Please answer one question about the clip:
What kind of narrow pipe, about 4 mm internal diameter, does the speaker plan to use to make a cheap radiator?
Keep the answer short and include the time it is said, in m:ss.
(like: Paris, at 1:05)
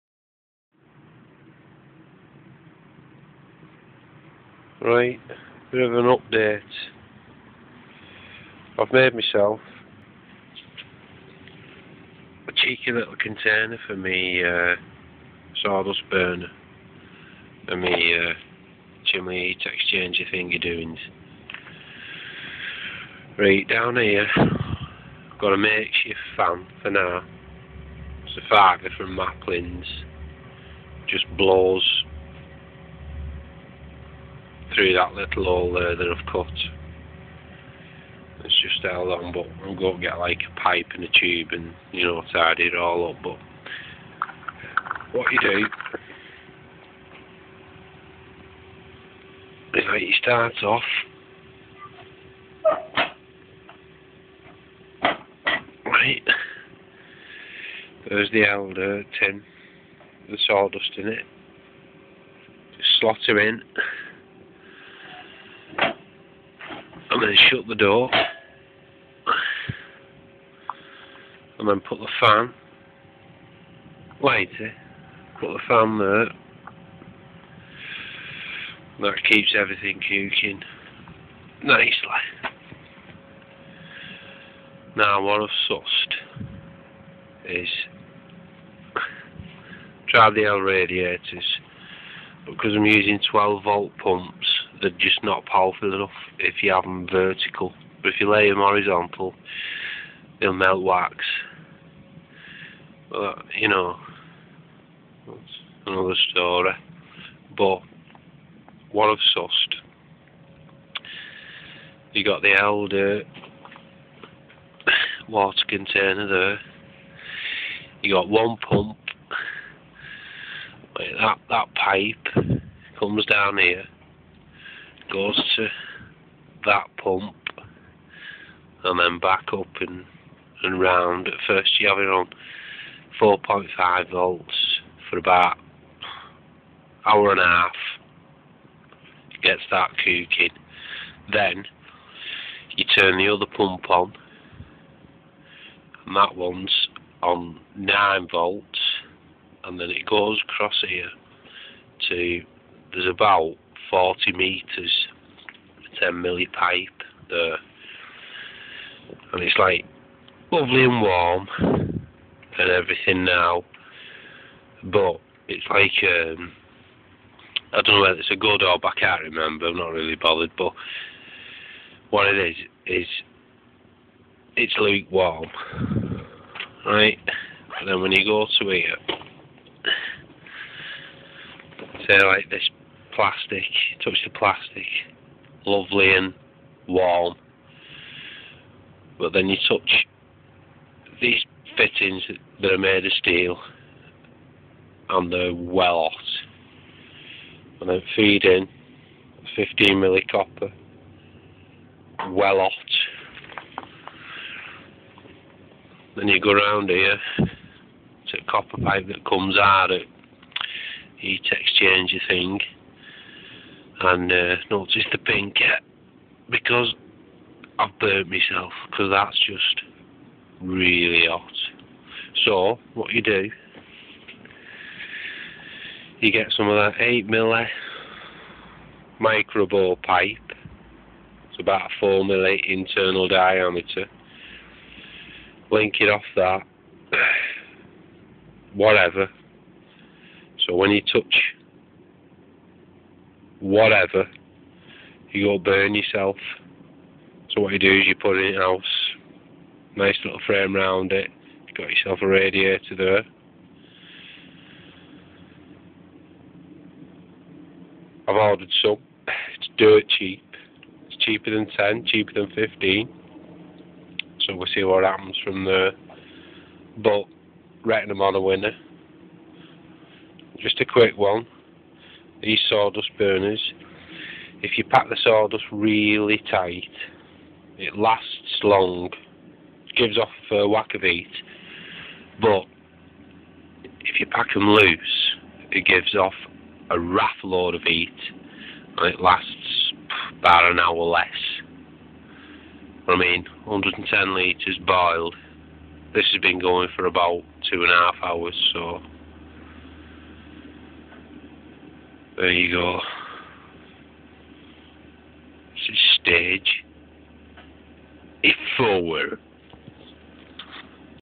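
8 microbore pipe, at 3:47.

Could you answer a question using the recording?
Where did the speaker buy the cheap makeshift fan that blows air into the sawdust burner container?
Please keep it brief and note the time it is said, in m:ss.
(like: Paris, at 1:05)
Maplin's, at 0:29.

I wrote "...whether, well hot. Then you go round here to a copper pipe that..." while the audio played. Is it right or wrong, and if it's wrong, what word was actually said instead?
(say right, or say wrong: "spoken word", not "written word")
wrong: "copper", not "whether".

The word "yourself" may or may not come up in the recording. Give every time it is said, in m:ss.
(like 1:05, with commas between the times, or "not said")
4:05, 4:11.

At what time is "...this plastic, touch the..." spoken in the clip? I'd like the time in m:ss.
3:02.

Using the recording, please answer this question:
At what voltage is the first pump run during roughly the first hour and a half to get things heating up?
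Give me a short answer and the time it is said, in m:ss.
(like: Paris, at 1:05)
4.5 volts, at 2:13.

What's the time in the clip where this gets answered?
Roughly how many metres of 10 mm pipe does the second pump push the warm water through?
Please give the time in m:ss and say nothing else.
2:33.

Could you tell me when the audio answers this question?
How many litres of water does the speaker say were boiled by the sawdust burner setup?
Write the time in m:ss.
4:53.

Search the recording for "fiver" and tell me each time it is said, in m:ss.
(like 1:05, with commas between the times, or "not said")
0:28.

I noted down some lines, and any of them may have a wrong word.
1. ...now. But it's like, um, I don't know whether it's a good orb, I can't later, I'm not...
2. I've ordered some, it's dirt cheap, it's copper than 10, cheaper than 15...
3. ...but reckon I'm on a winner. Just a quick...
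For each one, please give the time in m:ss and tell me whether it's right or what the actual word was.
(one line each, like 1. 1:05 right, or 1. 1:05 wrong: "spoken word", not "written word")
1. 2:43 wrong: "remember", not "later"
2. 4:18 wrong: "cheaper", not "copper"
3. 4:26 right.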